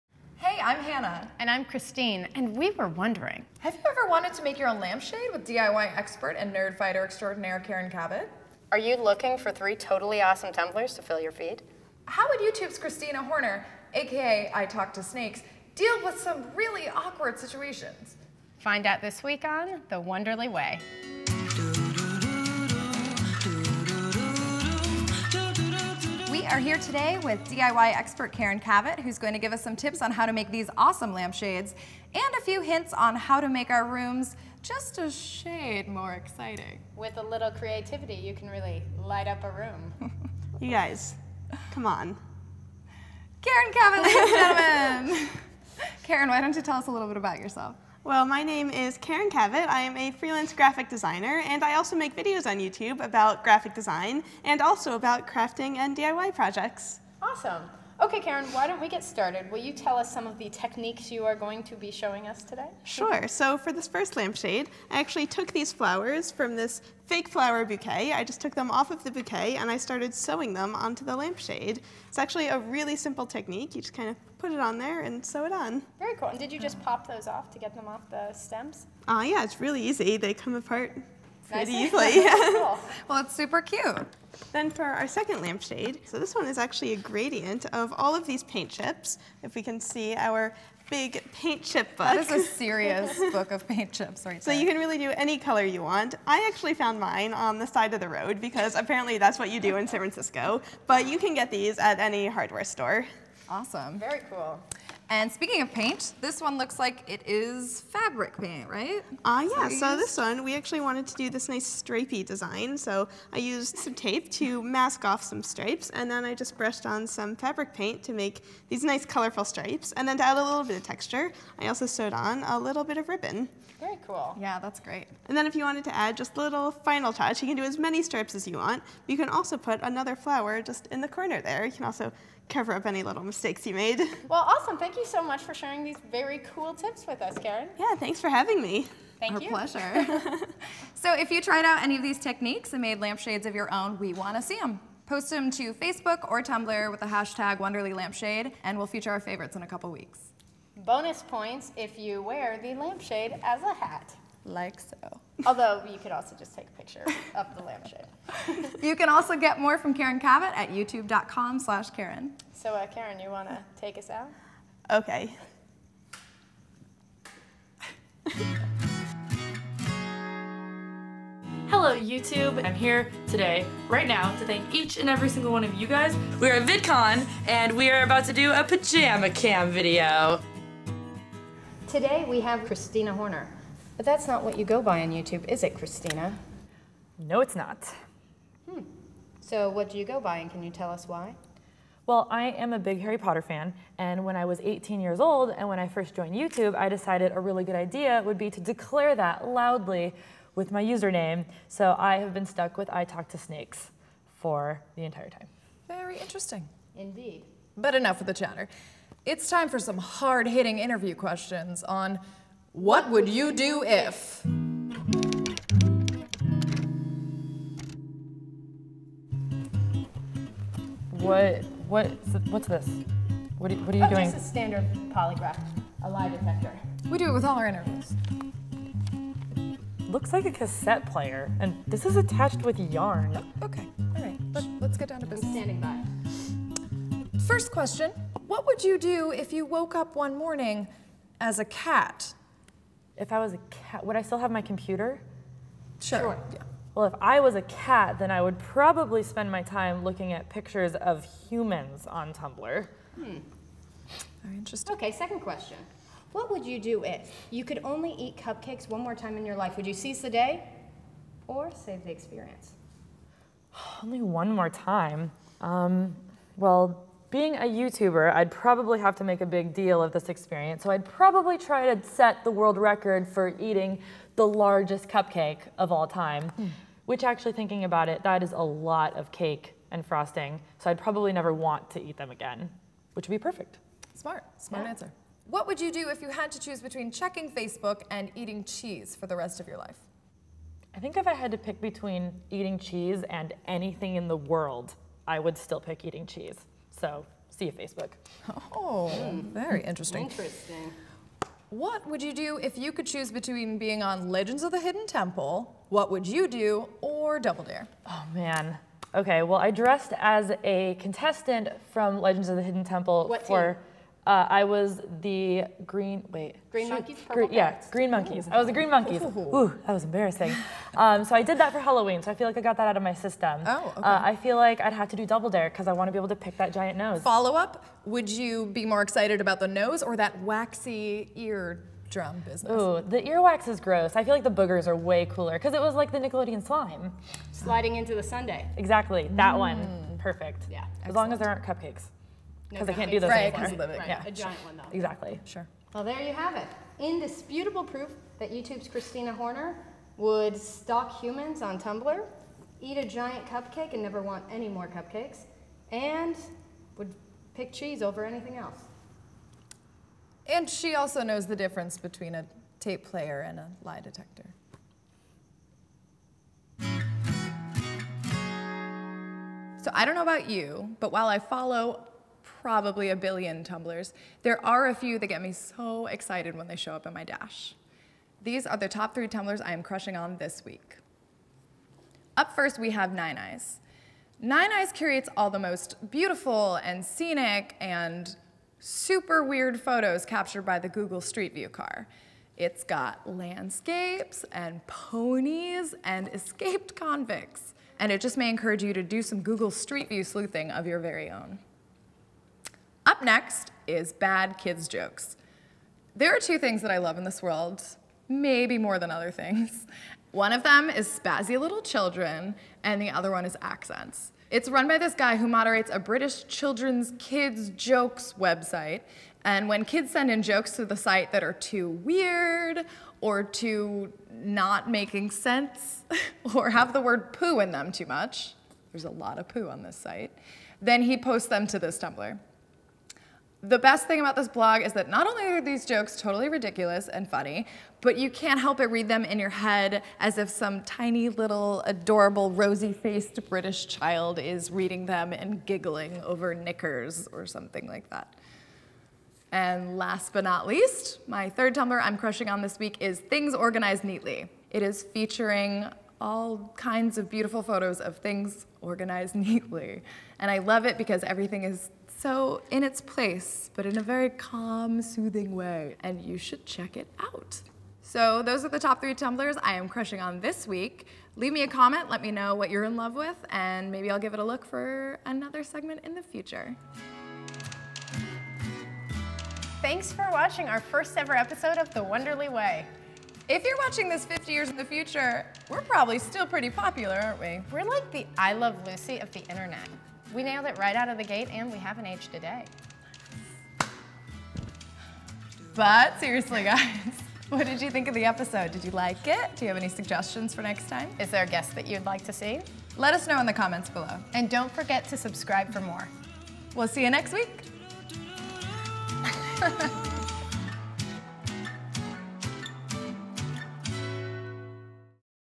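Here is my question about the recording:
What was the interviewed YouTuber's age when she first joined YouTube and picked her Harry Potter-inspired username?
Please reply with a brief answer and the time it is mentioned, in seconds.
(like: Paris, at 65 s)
18, at 194 s.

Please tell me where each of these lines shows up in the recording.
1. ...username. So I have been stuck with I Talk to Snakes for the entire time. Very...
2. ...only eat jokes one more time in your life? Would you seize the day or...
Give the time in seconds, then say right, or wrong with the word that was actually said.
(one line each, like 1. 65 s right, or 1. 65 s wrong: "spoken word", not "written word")
1. 200 s right
2. 257 s wrong: "cupcakes", not "jokes".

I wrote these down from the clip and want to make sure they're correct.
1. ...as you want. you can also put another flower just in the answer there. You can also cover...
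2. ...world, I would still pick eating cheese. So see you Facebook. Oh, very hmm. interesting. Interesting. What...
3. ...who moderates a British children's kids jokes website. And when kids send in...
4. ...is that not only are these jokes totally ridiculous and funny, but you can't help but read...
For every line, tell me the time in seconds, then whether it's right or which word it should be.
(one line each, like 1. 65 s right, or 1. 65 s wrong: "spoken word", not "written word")
1. 128 s wrong: "corner", not "answer"
2. 294 s right
3. 415 s right
4. 434 s right.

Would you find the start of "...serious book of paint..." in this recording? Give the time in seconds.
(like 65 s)
92 s.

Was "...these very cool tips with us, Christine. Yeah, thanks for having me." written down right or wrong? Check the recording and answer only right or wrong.
wrong.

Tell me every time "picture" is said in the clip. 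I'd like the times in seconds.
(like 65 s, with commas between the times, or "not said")
156 s, 250 s.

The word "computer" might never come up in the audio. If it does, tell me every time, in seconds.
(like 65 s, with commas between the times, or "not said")
244 s.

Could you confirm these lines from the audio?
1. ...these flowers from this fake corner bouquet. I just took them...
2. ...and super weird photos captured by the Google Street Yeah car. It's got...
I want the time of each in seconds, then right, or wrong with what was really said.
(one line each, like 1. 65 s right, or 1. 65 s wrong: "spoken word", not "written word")
1. 65 s wrong: "flower", not "corner"
2. 387 s wrong: "View", not "Yeah".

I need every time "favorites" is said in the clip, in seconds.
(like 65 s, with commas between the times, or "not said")
149 s.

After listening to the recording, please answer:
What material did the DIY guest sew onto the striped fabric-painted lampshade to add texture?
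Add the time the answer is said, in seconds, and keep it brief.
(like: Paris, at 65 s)
Ribbon, at 123 s.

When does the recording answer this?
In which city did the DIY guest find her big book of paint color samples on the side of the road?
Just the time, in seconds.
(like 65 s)
99 s.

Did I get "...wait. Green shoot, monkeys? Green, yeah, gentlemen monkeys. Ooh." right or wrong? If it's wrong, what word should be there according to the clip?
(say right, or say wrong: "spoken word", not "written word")
wrong: "green", not "gentlemen".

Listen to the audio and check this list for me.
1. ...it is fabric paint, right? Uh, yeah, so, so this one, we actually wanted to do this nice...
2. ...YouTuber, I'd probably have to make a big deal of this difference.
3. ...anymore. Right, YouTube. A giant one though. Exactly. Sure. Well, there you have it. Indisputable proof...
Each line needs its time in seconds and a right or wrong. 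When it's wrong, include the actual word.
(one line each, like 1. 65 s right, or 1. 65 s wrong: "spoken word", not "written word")
1. 107 s right
2. 267 s wrong: "experience", not "difference"
3. 343 s wrong: "Yeah", not "YouTube".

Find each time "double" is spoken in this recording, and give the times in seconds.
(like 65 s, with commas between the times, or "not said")
307 s, 325 s.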